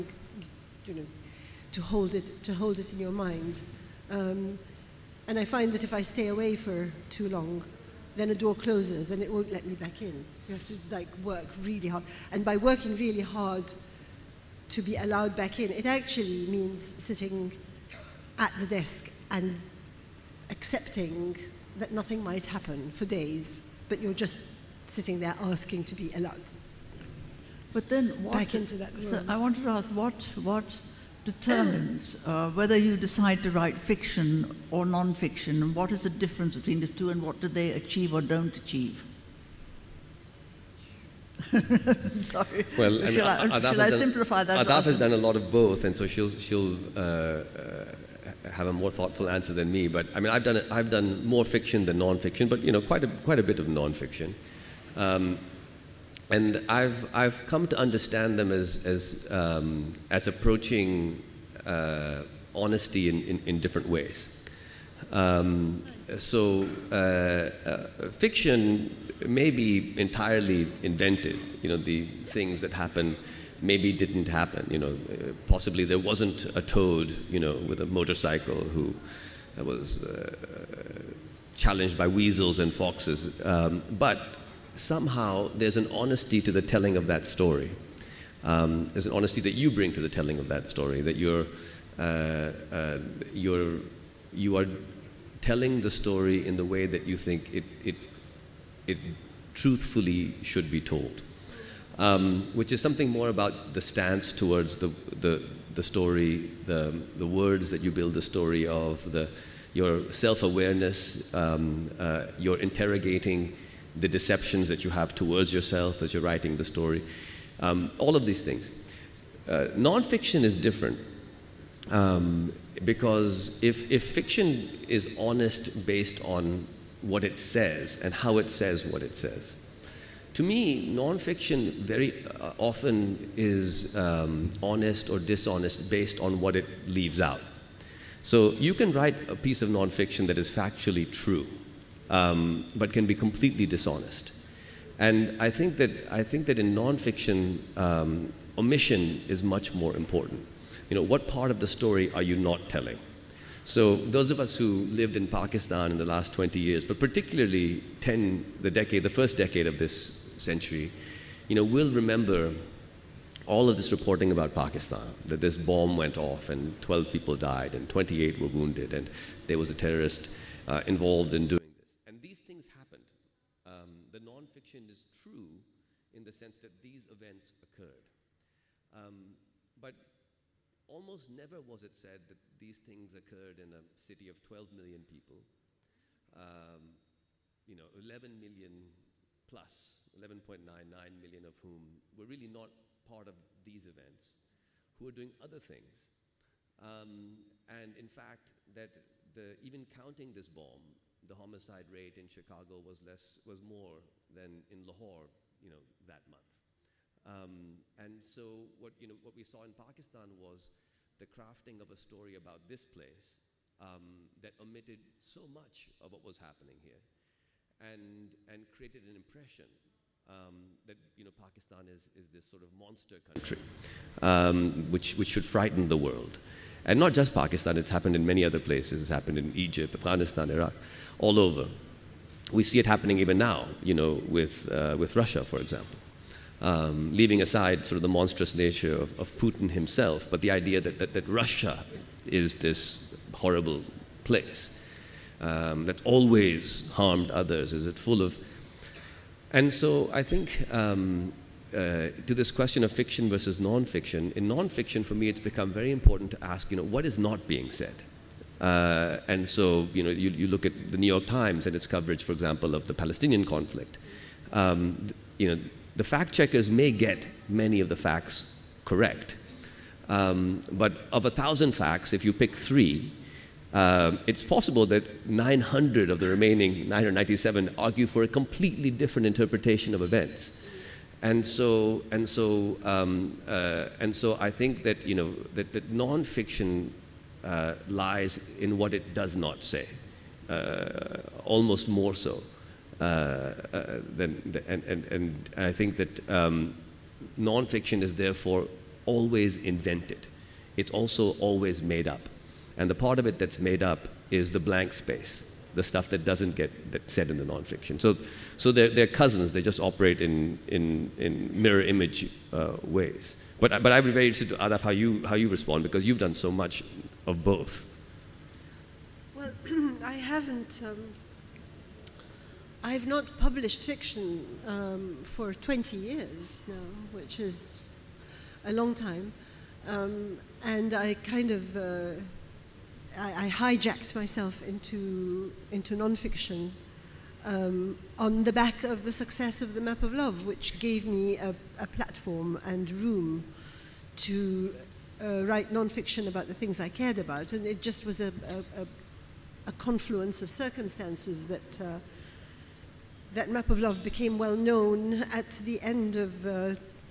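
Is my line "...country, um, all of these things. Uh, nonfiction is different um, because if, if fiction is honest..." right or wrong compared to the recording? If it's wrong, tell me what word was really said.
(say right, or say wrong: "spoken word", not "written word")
wrong: "story", not "country".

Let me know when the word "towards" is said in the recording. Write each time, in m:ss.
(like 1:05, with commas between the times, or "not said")
1:44, 1:55.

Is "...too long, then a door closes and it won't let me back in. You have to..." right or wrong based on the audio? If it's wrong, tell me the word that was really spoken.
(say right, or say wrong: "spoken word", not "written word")
right.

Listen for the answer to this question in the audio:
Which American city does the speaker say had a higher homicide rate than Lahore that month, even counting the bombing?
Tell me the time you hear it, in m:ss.
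3:22.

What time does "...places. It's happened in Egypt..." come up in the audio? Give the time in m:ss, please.
3:48.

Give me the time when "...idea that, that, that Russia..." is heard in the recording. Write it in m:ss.
4:00.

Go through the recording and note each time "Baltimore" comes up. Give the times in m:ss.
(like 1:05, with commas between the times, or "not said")
not said.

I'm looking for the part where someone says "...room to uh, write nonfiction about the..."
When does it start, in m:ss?
5:42.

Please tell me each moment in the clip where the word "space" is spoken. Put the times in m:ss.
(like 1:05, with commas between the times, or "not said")
5:04.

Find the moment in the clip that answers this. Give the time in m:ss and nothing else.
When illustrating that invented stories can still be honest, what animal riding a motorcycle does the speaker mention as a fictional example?
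1:16.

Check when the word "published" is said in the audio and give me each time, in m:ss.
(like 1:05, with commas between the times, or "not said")
5:23.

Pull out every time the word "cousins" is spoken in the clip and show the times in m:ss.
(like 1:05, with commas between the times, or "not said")
5:09.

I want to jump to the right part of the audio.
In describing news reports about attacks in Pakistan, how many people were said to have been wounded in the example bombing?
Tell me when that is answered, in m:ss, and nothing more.
2:47.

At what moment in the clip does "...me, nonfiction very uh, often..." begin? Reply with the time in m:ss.
2:10.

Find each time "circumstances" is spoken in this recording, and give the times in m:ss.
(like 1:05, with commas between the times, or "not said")
5:50.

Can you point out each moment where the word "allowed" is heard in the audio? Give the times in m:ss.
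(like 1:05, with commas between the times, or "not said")
0:14, 0:26.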